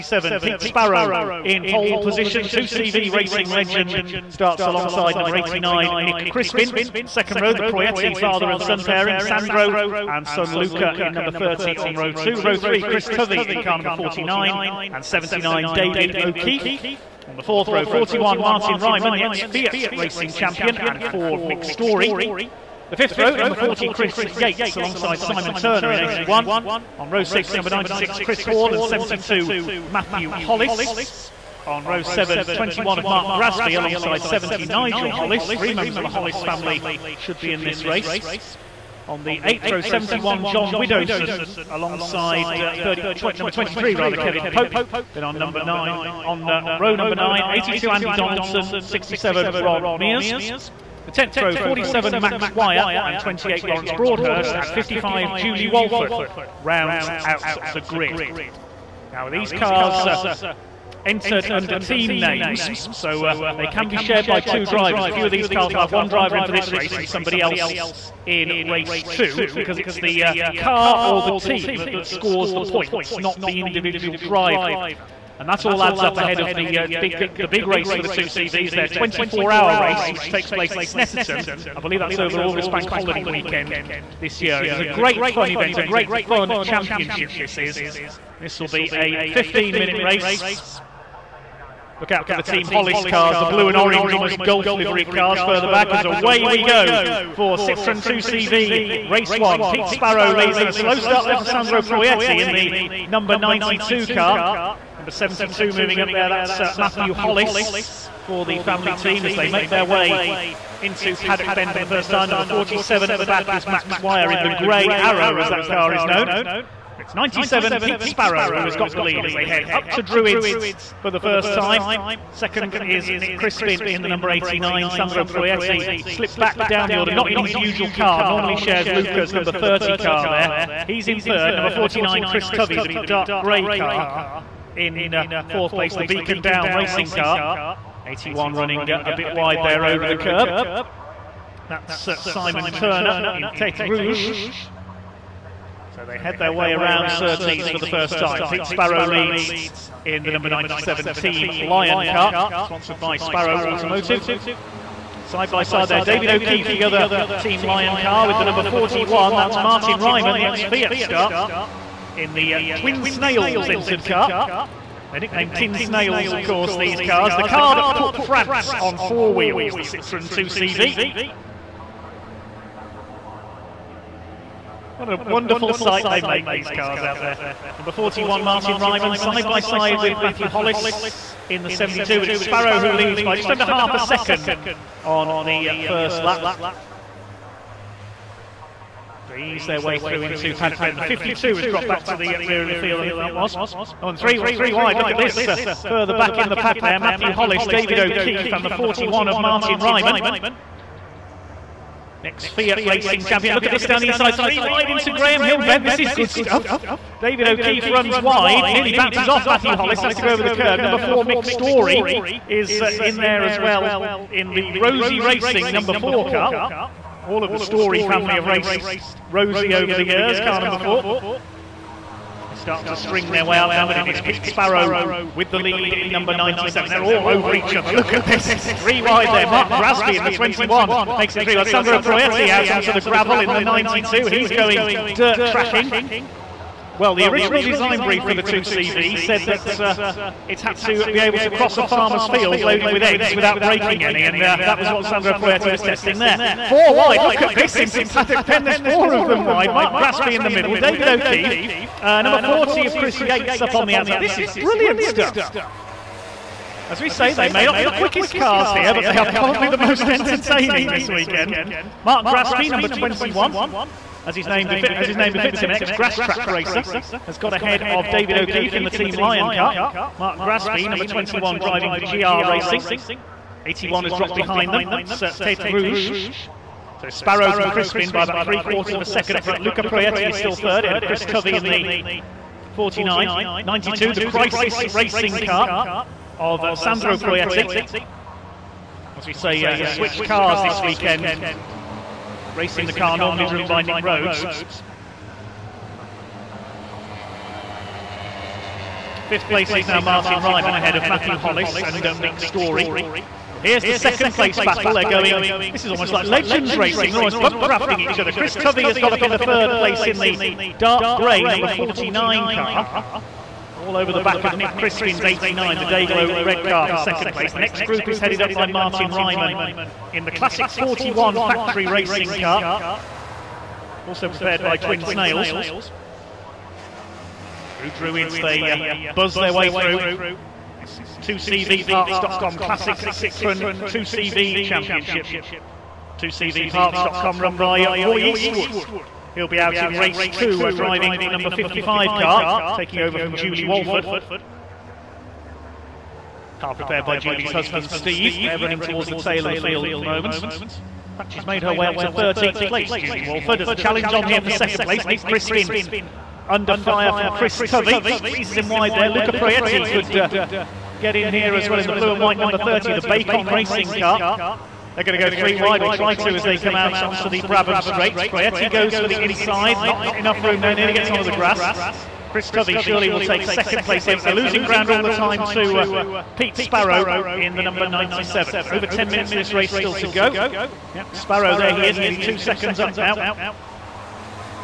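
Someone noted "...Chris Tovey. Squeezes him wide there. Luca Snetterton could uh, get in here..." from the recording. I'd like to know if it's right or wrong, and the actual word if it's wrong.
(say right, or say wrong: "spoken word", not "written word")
wrong: "Proietti", not "Snetterton".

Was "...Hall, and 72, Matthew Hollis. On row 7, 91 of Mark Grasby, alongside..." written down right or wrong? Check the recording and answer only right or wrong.
wrong.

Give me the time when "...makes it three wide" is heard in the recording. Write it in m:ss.
3:51.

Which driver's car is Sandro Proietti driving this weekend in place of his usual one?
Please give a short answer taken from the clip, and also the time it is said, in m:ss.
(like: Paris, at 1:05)
Nick Rhodes, at 4:53.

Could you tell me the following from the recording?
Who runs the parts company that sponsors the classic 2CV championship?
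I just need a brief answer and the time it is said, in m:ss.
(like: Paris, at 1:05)
Roy Eastwood, at 5:38.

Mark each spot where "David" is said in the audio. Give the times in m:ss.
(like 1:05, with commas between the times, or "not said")
0:15, 2:36, 3:17, 3:27, 4:10, 4:28.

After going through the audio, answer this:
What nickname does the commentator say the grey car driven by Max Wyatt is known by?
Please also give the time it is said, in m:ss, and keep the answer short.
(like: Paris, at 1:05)
the grey arrow, at 1:54.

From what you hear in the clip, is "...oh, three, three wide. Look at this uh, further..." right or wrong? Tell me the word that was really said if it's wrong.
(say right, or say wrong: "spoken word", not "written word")
right.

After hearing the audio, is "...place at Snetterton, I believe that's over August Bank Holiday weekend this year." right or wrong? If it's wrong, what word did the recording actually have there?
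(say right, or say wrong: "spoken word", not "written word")
right.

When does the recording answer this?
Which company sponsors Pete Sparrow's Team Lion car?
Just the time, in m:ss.
2:33.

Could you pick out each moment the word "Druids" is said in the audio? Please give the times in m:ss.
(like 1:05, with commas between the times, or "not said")
2:00, 5:27.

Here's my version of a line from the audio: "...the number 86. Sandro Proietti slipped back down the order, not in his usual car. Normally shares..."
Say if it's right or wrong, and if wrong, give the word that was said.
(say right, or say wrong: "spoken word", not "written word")
wrong: "89", not "86".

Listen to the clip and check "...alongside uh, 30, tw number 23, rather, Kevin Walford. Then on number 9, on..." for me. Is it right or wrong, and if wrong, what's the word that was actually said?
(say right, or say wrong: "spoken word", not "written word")
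wrong: "Pope", not "Walford".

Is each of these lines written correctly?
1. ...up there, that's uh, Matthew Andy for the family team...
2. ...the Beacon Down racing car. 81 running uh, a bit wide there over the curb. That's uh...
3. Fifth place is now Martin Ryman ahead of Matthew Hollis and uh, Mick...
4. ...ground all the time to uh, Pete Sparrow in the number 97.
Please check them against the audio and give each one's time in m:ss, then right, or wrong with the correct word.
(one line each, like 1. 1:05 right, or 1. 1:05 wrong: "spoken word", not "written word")
1. 1:46 wrong: "Hollis", not "Andy"
2. 2:15 right
3. 4:59 right
4. 6:14 right.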